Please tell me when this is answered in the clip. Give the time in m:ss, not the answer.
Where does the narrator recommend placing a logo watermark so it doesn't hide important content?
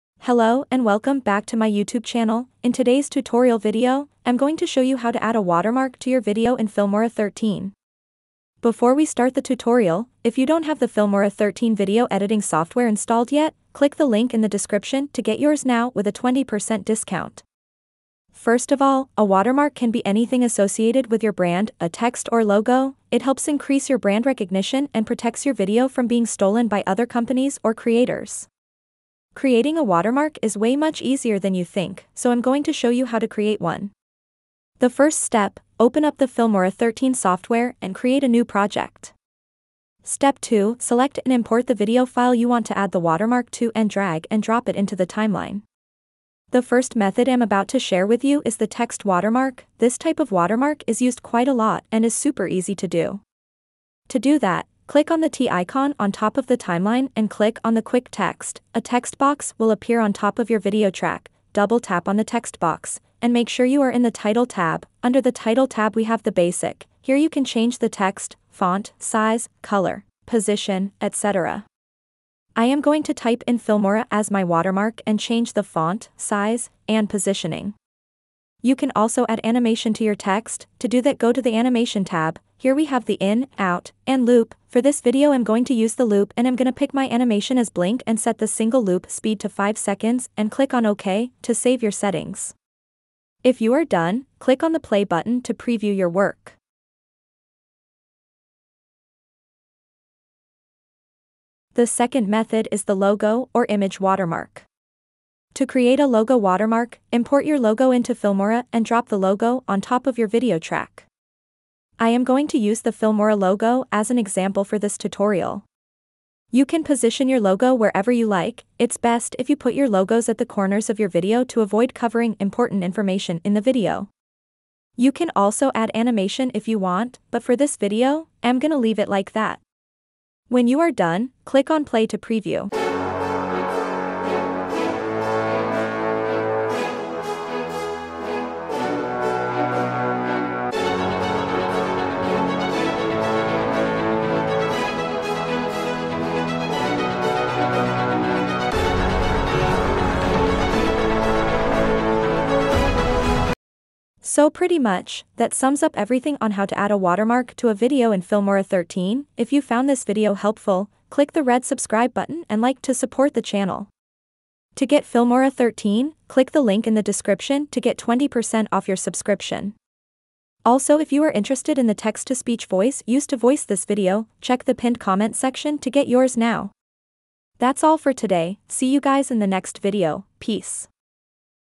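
2:00.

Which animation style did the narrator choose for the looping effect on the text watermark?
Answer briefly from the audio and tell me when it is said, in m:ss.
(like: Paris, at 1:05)
blink, at 1:27.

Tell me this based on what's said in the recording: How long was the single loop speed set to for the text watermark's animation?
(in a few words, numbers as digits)
5 seconds.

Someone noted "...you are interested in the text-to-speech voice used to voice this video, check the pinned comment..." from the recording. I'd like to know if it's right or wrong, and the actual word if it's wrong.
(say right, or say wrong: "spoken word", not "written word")
right.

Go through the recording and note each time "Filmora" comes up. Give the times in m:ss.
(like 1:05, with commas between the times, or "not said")
0:06, 0:10, 0:36, 1:13, 1:48, 1:52, 2:38, 2:45.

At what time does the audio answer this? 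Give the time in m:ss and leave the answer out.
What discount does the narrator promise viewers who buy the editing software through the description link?
0:16.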